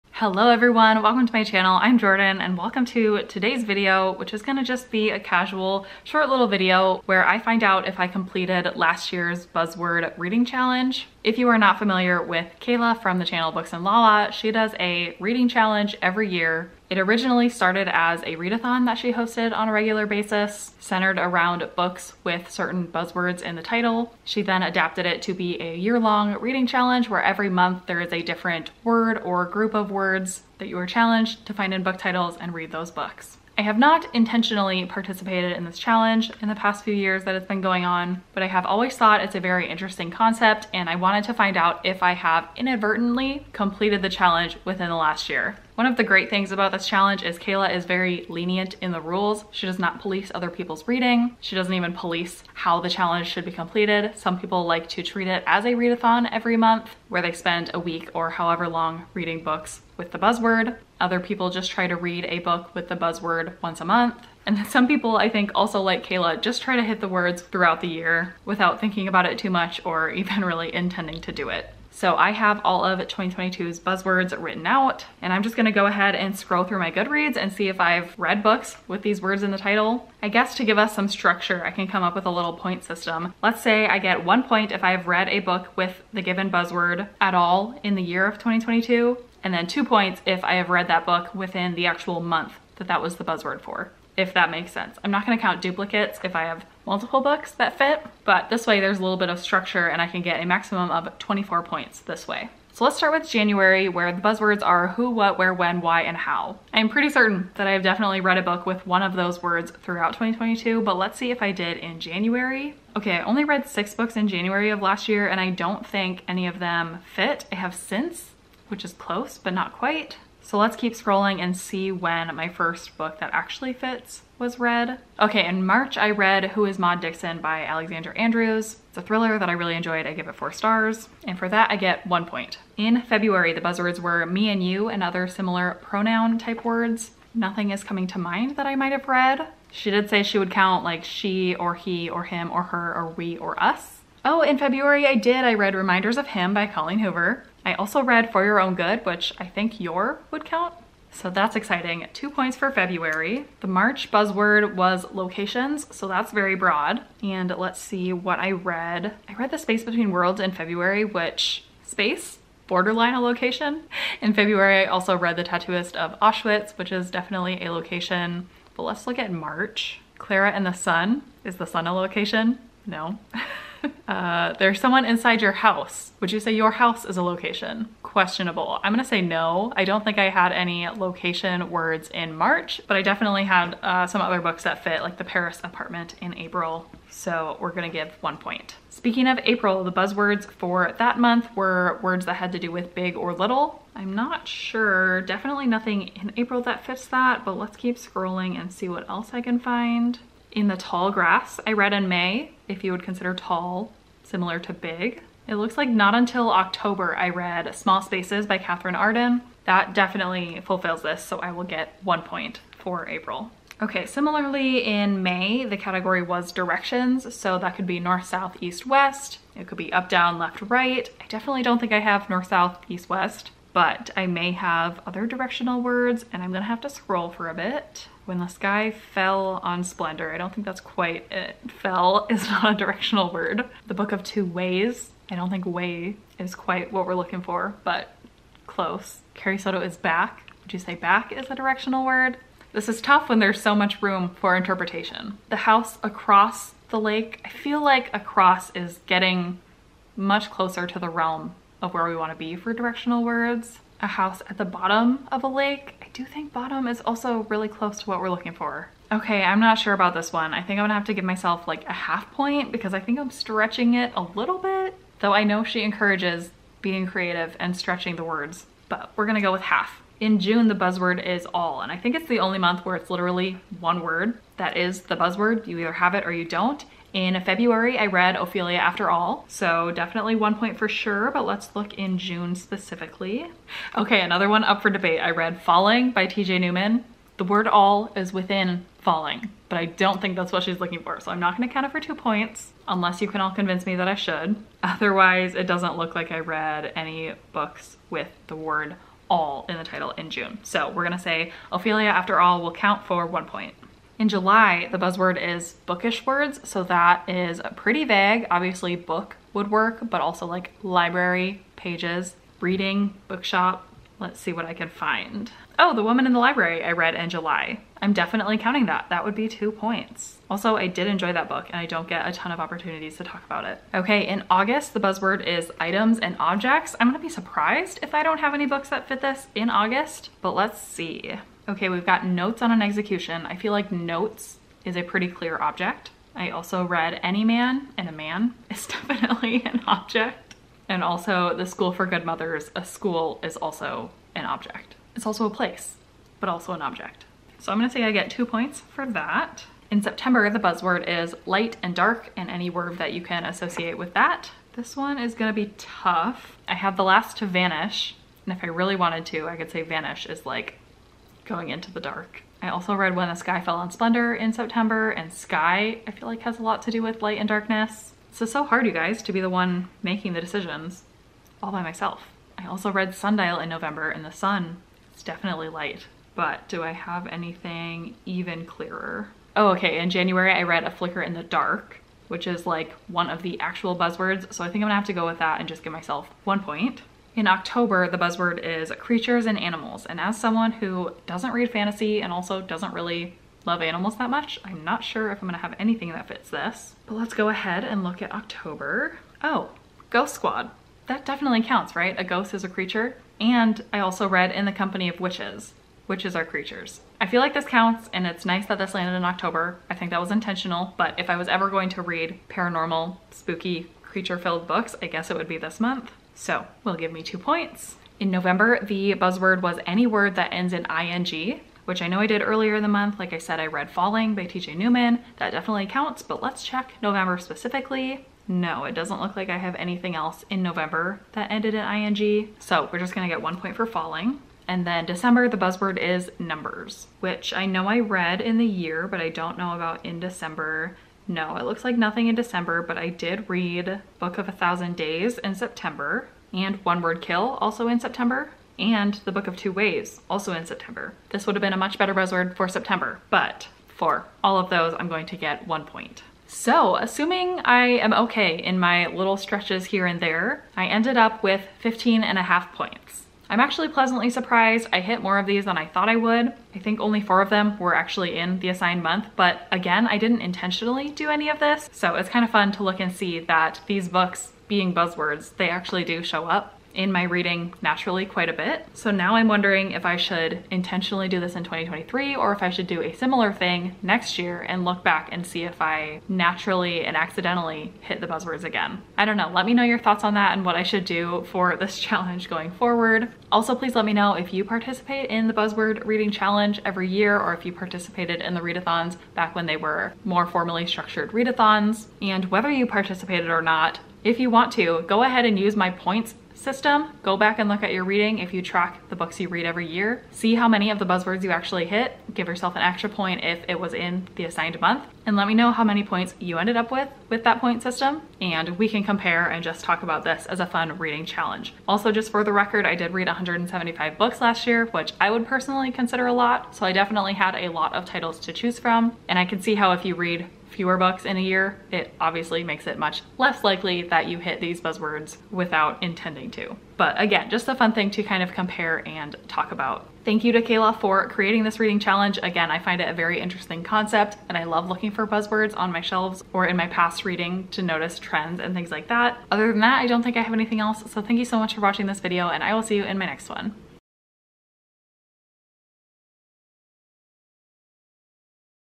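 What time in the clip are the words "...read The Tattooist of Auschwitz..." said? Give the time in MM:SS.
02:45.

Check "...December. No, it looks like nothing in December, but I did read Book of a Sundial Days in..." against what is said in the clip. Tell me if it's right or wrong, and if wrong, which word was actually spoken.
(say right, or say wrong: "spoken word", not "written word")
wrong: "Thousand", not "Sundial".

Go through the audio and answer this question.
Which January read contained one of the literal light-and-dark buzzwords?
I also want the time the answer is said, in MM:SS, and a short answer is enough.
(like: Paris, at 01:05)
A Flicker in the Dark, at 06:20.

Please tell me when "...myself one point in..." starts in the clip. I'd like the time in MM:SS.
06:25.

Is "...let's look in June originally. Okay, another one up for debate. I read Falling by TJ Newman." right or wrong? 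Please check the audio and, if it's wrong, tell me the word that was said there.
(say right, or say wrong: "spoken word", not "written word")
wrong: "specifically", not "originally".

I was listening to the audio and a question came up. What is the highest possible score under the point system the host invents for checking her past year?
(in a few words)
24.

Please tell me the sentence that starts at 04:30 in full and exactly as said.
In June, the buzzword is all, and I think it's the only month where it's literally one word that is the buzzword.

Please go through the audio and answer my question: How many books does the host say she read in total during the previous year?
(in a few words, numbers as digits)
175.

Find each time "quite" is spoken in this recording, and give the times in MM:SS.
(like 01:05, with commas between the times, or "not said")
01:59, 03:50, 03:56, 07:58.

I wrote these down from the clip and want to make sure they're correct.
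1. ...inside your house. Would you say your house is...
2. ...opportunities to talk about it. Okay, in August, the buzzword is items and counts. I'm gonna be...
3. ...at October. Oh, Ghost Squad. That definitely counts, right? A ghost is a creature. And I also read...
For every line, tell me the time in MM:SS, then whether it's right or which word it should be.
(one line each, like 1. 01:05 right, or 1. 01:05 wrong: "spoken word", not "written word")
1. 02:55 right
2. 05:22 wrong: "objects", not "counts"
3. 06:38 right.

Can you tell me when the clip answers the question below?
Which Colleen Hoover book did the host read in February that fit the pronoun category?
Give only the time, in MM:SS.
02:25.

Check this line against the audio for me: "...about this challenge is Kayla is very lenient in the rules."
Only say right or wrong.
right.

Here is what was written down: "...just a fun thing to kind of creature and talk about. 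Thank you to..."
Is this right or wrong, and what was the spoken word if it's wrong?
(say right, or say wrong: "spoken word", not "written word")
wrong: "compare", not "creature".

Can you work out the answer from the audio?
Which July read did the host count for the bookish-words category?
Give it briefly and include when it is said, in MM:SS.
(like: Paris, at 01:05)
The Woman in the Library, at 05:15.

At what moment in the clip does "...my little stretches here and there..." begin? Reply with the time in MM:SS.
07:38.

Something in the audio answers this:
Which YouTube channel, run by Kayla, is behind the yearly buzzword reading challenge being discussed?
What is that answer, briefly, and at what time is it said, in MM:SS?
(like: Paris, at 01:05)
Books and Lala, at 00:13.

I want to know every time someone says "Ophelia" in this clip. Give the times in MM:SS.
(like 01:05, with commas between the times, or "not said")
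04:38, 05:01.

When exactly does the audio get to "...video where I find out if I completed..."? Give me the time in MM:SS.
00:06.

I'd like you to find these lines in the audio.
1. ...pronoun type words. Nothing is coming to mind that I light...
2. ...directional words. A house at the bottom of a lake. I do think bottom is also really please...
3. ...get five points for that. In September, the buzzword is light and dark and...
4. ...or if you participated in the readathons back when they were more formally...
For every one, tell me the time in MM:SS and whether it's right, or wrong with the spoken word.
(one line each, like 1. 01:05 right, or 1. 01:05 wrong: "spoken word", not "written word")
1. 02:15 wrong: "might", not "light"
2. 04:12 wrong: "close", not "please"
3. 05:48 wrong: "two", not "five"
4. 08:17 right.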